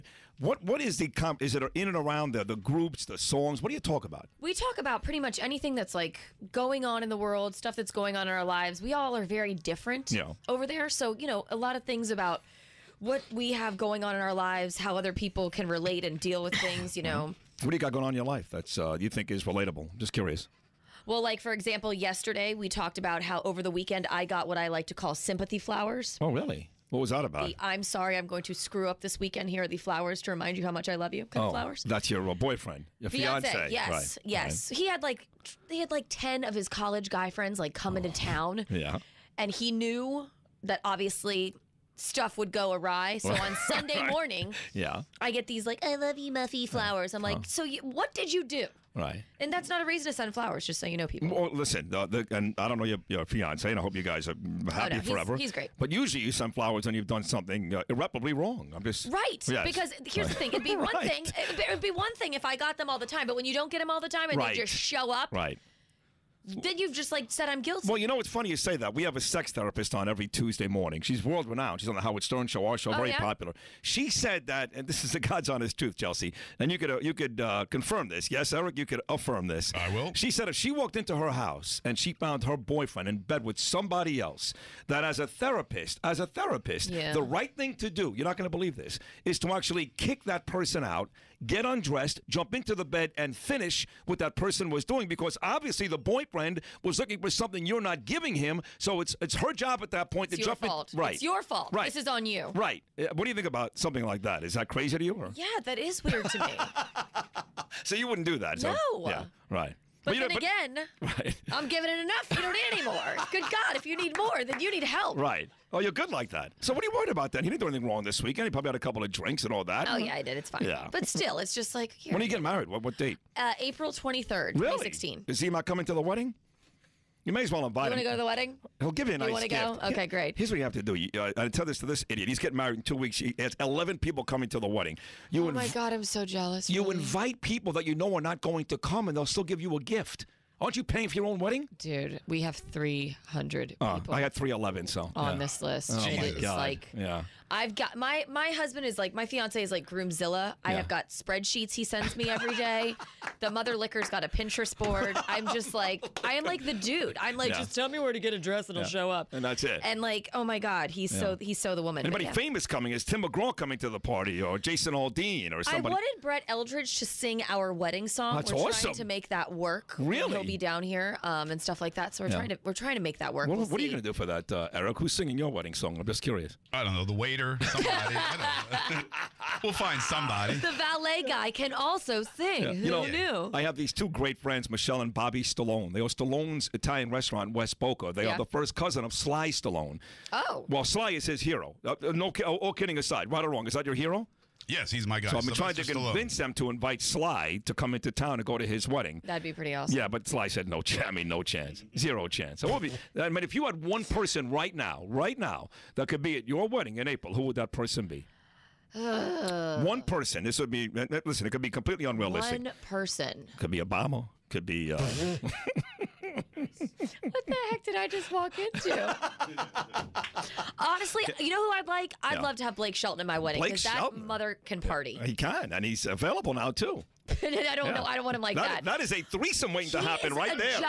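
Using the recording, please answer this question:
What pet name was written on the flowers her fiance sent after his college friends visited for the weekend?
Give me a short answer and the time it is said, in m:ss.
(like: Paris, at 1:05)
Muffy, at 0:46.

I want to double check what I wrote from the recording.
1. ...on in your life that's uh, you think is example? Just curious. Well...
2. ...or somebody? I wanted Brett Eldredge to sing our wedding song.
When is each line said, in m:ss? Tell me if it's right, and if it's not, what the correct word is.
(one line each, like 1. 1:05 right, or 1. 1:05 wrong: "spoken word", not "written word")
1. 0:18 wrong: "relatable", not "example"
2. 2:45 right.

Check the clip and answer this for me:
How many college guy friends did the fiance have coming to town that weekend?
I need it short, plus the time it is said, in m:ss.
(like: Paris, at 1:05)
10, at 0:36.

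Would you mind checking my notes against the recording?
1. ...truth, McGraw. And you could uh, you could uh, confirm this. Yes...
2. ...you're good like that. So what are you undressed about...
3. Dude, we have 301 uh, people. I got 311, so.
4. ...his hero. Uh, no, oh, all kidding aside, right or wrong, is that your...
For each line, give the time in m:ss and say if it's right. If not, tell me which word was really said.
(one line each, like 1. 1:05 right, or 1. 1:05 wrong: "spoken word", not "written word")
1. 1:15 wrong: "Chelsea", not "McGraw"
2. 1:55 wrong: "worried", not "undressed"
3. 2:21 wrong: "300", not "301"
4. 3:11 right.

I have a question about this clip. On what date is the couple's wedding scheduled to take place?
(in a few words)
April 23rd, 2016.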